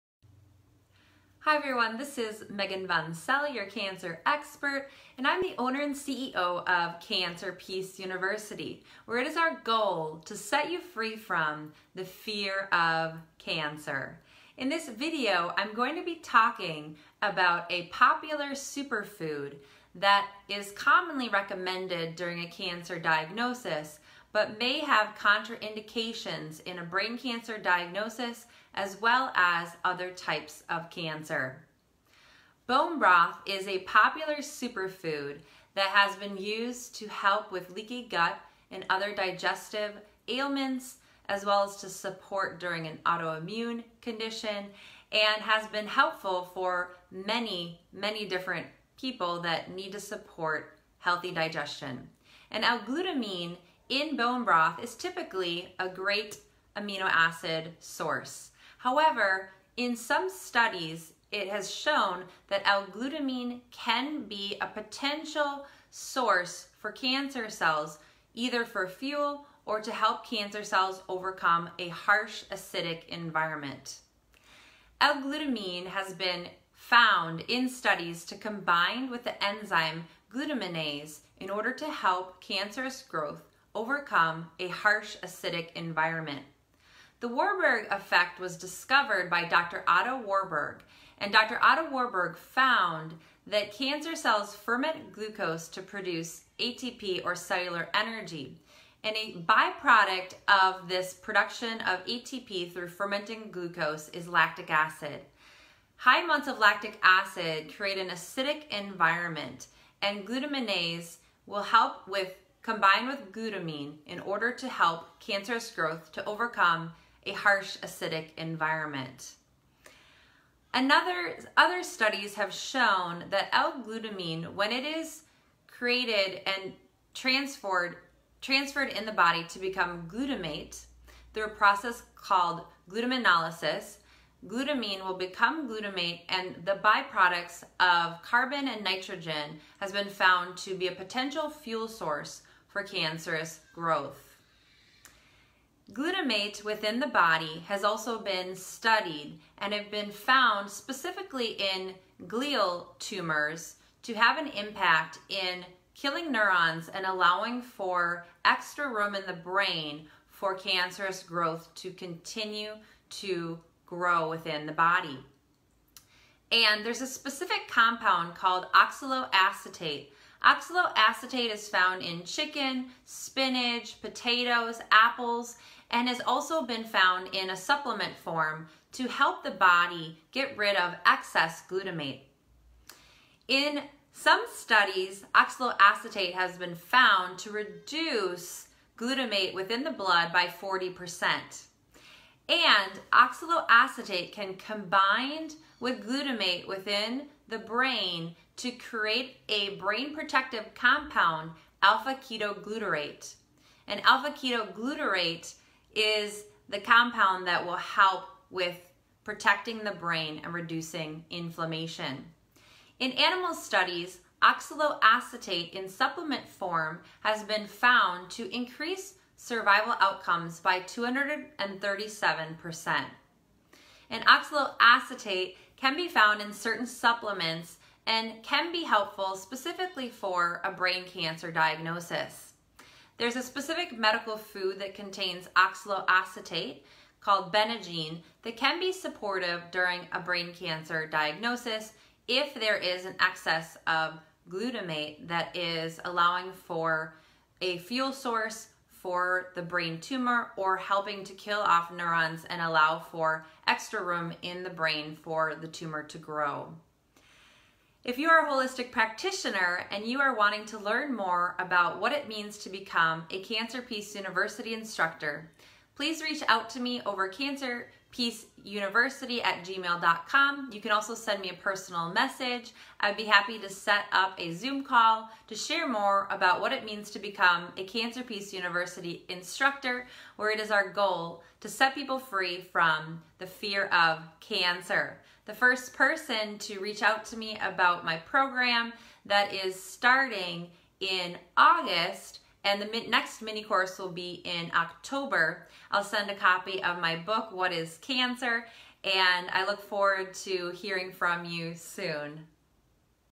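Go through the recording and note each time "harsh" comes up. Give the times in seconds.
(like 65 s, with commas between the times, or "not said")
71 s, 84 s, 117 s.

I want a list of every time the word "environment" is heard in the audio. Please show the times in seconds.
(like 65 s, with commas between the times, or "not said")
73 s, 85 s, 108 s, 118 s.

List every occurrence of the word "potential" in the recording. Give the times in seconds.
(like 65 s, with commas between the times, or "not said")
64 s, 140 s.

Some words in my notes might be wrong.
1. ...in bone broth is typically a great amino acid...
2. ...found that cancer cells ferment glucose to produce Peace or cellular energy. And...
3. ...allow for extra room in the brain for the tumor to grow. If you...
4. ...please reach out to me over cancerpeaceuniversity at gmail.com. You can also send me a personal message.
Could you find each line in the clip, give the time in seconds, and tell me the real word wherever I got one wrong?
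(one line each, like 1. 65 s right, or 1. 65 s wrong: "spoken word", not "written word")
1. 53 s right
2. 92 s wrong: "ATP", not "Peace"
3. 252 s right
4. 266 s right.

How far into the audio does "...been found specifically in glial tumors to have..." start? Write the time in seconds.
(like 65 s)
149 s.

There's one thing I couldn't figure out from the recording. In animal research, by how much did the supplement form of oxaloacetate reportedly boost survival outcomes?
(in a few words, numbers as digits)
237%.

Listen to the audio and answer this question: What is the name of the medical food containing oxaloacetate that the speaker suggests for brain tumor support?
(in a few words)
Benagene.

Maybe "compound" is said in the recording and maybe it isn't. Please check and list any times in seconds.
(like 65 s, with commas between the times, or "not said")
167 s, 200 s, 206 s.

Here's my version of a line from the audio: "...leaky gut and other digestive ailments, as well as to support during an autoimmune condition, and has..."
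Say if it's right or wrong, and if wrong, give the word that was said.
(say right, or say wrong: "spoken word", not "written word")
right.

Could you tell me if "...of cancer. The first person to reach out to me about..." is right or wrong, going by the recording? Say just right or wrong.
right.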